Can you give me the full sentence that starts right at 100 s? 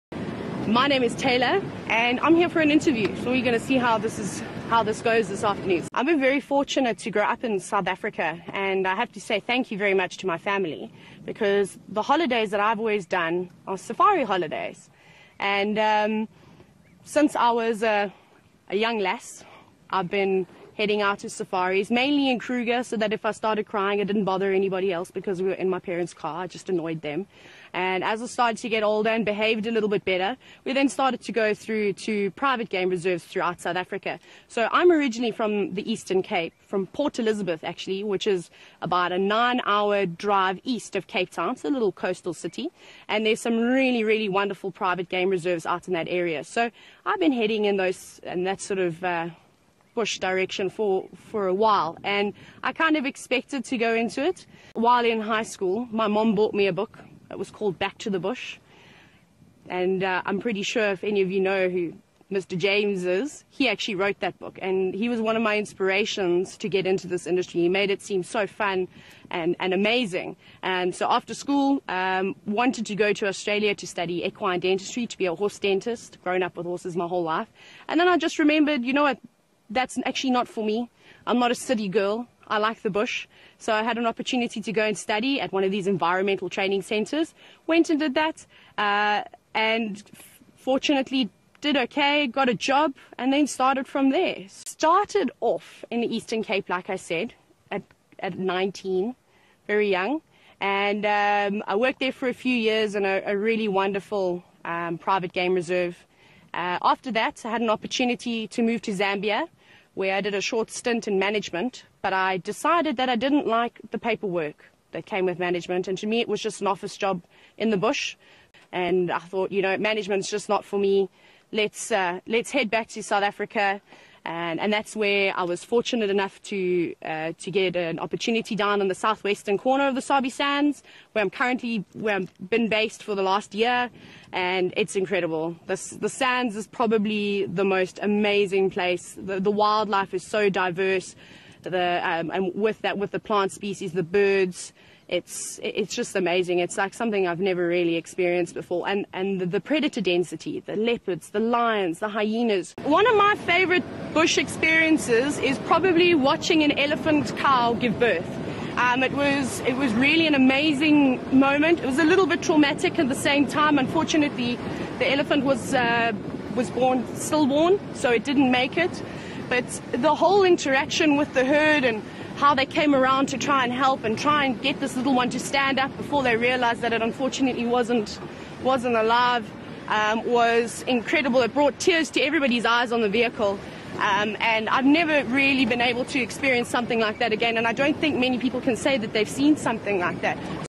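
And um, I worked there for a few years in a, a really wonderful um, private game reserve.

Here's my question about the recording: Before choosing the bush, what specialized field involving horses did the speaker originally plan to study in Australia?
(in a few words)
equine dentistry.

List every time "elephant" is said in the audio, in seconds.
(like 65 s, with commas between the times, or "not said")
156 s, 165 s.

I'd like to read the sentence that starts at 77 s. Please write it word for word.
And then I just remembered, you know what, that's actually not for me.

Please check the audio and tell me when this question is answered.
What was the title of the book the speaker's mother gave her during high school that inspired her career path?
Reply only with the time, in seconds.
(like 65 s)
57 s.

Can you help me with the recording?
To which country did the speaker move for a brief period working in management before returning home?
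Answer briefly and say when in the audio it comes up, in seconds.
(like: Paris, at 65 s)
Zambia, at 108 s.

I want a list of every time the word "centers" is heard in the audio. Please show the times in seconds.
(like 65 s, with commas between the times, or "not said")
86 s.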